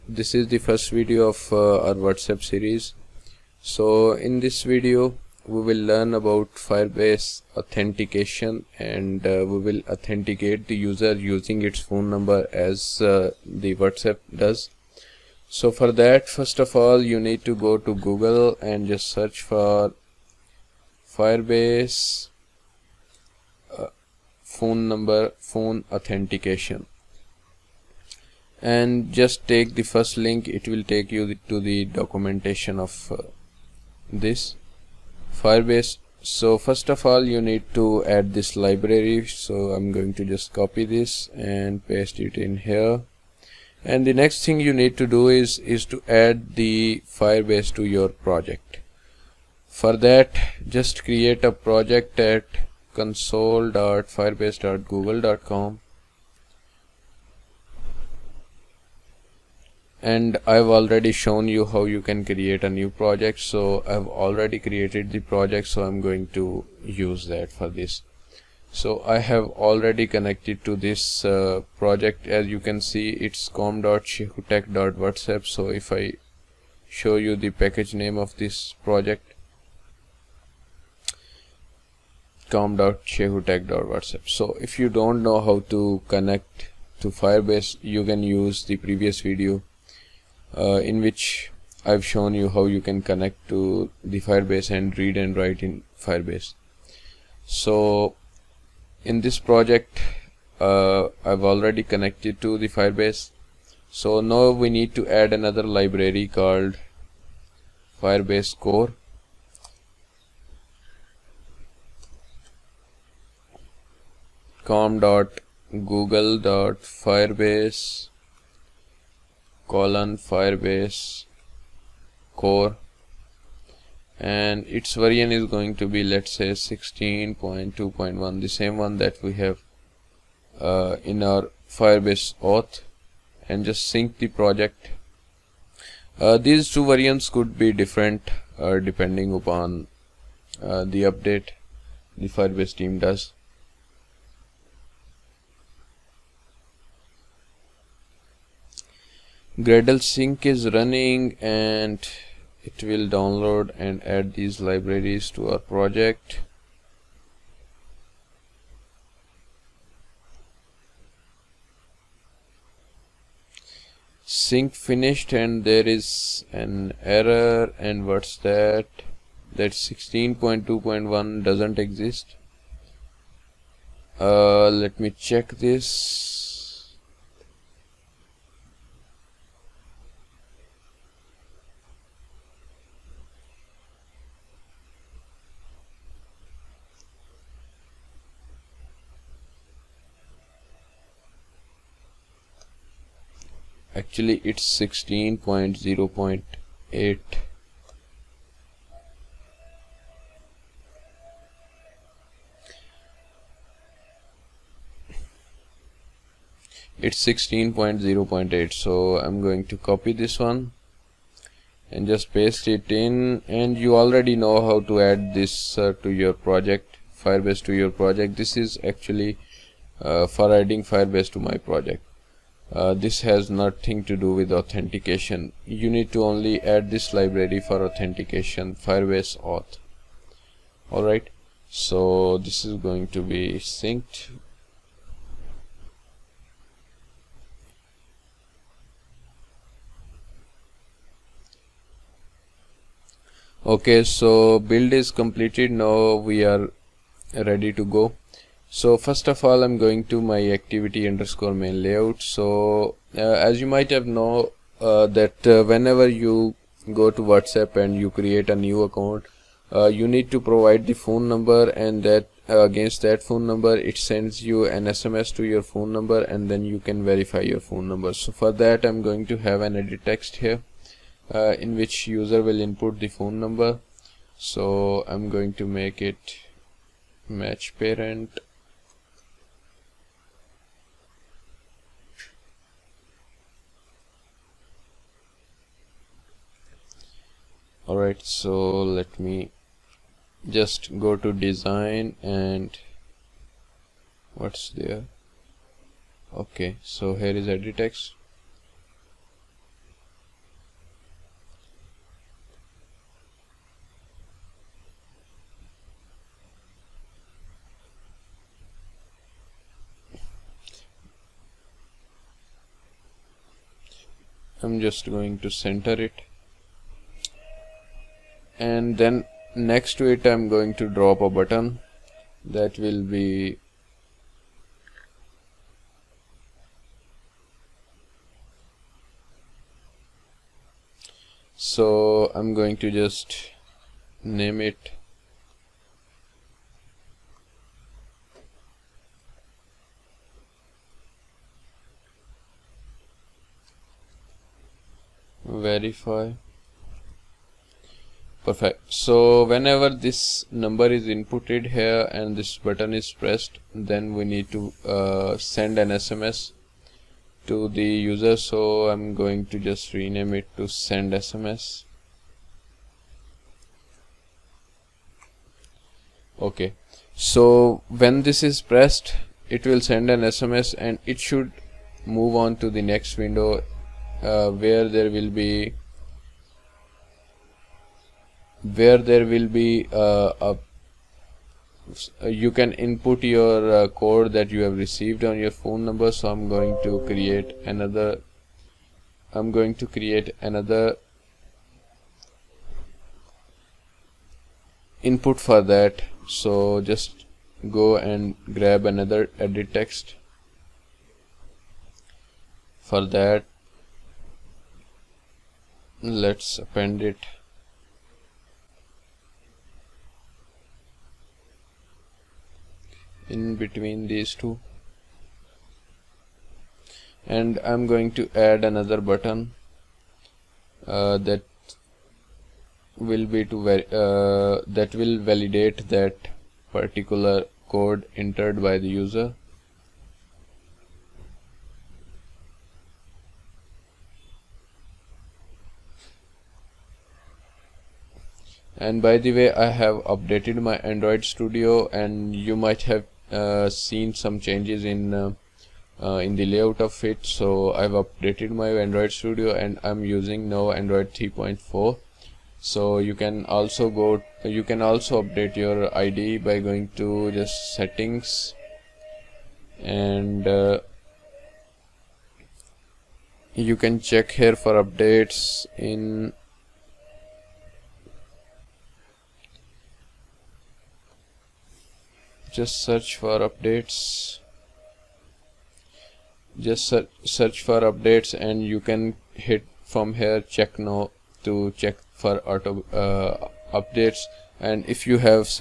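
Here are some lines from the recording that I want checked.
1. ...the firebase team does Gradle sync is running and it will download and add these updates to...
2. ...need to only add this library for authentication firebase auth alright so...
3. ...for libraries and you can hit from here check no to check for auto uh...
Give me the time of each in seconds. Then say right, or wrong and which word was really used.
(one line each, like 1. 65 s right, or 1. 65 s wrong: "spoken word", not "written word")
1. 142 s wrong: "libraries", not "updates"
2. 225 s right
3. 477 s wrong: "updates", not "libraries".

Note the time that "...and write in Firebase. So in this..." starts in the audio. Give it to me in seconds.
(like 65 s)
95 s.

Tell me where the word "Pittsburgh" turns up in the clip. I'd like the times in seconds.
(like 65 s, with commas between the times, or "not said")
not said.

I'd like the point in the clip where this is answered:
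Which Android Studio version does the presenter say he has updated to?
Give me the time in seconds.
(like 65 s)
451 s.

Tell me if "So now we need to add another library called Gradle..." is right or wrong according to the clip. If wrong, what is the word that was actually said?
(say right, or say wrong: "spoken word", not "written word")
wrong: "Firebase", not "Gradle".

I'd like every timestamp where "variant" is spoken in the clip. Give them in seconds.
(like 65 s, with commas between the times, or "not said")
124 s, 136 s.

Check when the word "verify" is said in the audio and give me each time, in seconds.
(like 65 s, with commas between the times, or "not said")
267 s, 345 s.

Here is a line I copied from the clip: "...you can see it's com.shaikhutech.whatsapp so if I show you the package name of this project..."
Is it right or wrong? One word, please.
right.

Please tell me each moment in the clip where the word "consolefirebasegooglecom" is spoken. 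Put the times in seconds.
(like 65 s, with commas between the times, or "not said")
52 s.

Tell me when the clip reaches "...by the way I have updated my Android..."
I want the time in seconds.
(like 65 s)
439 s.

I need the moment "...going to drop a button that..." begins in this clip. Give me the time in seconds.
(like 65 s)
320 s.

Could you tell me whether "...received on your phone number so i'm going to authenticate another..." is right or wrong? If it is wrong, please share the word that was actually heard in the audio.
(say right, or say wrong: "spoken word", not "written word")
wrong: "create", not "authenticate".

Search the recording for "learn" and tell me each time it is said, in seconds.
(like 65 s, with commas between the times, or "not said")
5 s.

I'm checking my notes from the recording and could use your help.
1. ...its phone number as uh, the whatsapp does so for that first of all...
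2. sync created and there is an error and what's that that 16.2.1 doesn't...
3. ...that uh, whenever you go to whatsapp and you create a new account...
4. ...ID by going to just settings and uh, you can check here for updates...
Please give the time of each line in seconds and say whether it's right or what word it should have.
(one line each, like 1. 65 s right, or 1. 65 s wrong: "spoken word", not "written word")
1. 11 s right
2. 164 s wrong: "finished", not "created"
3. 255 s right
4. 455 s right.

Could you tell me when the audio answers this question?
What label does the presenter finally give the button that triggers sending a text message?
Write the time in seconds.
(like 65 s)
360 s.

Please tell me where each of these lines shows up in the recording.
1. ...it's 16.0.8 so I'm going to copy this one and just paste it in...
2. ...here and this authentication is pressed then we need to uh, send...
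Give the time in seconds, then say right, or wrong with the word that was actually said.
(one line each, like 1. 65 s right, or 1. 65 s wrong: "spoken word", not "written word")
1. 207 s right
2. 351 s wrong: "button", not "authentication".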